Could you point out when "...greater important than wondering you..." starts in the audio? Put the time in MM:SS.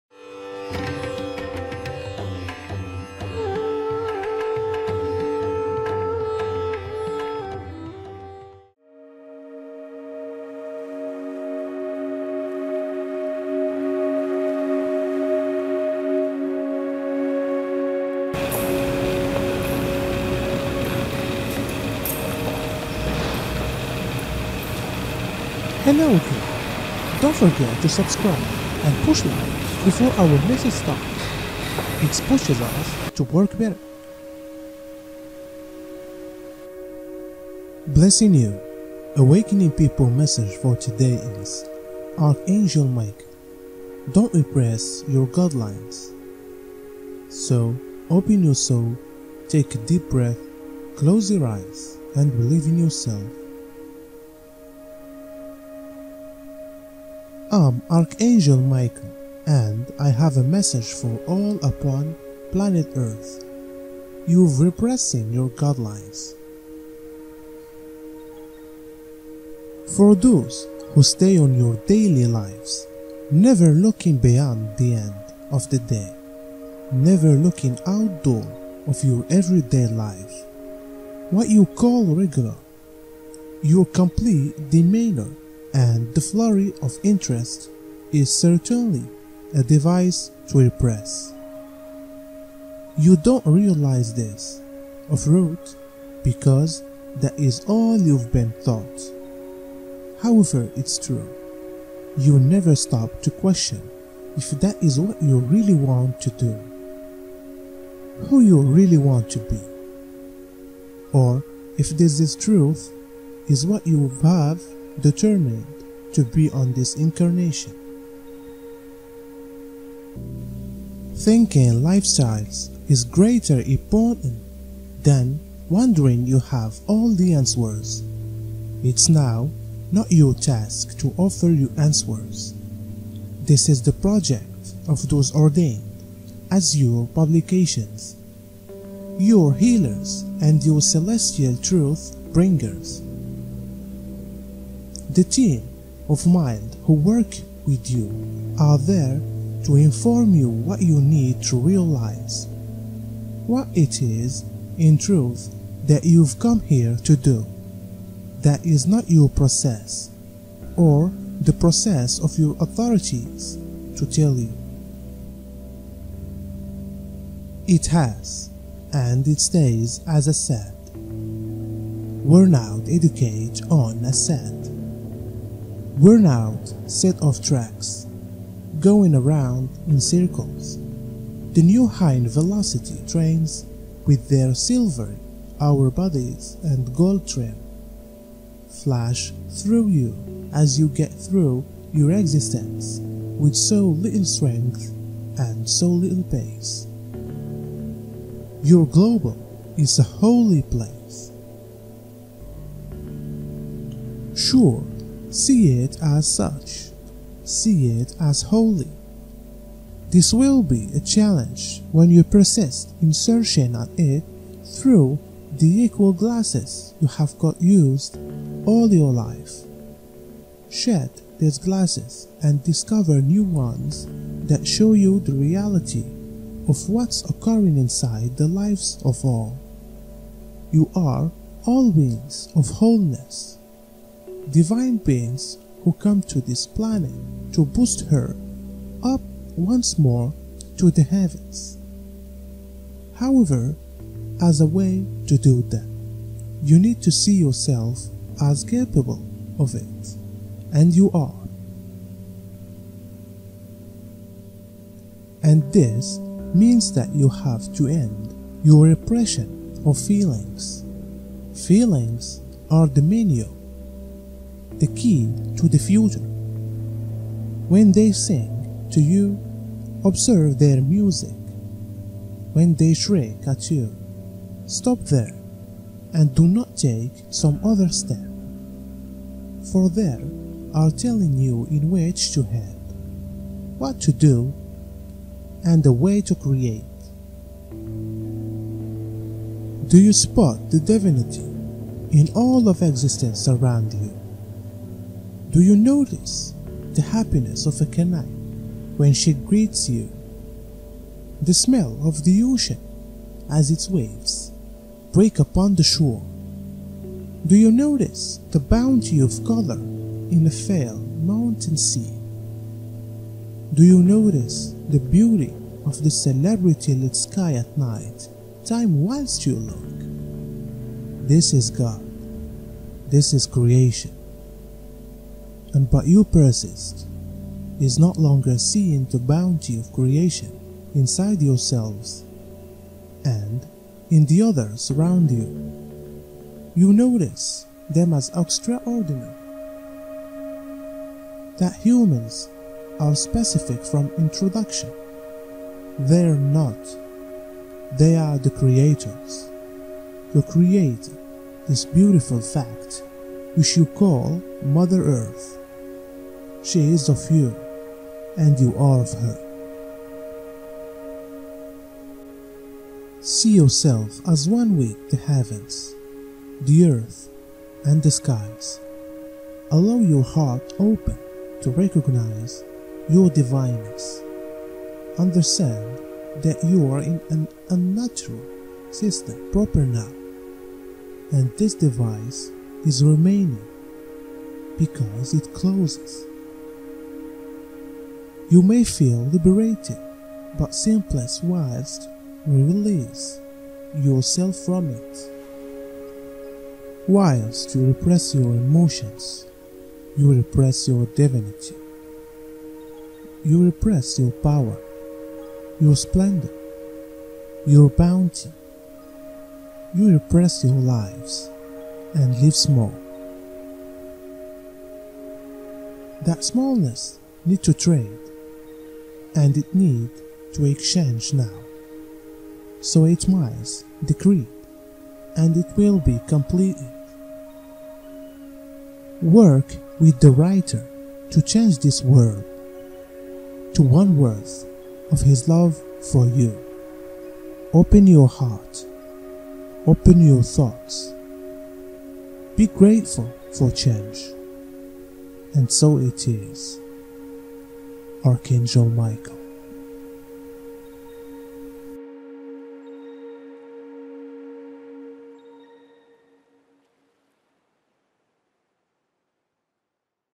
02:03.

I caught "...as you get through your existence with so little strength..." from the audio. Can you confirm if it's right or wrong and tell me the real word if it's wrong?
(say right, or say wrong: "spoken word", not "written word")
right.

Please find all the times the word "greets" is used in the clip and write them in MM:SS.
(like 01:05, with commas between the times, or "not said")
04:59.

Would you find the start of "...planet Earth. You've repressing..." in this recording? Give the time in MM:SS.
01:02.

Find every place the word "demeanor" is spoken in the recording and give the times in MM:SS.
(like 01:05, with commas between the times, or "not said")
01:24.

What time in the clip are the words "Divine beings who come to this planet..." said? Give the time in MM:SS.
03:54.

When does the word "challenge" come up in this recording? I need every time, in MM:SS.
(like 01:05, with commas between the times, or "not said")
03:30.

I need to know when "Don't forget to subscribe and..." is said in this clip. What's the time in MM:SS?
00:27.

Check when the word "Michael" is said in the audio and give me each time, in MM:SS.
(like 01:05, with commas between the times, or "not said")
00:58, 07:28.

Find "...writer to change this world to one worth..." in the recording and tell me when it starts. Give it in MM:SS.
07:10.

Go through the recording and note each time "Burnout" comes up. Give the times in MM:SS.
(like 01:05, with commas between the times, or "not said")
02:50, 02:55.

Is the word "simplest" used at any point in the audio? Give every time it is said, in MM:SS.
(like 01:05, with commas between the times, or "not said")
06:30.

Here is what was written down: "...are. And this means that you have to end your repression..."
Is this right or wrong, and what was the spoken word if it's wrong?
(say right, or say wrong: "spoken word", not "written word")
right.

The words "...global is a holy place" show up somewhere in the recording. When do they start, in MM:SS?
03:18.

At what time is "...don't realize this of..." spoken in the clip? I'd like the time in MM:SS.
01:33.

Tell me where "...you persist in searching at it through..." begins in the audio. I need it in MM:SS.
03:32.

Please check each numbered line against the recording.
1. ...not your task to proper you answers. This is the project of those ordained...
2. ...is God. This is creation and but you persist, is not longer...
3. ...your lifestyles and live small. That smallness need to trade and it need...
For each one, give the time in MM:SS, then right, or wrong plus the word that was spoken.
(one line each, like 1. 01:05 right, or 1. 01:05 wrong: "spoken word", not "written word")
1. 02:09 wrong: "offer", not "proper"
2. 05:21 right
3. 06:50 wrong: "lives", not "lifestyles".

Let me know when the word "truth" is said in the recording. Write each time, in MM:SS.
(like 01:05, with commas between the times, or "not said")
01:52, 02:21, 02:34.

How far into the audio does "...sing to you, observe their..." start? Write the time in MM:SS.
04:28.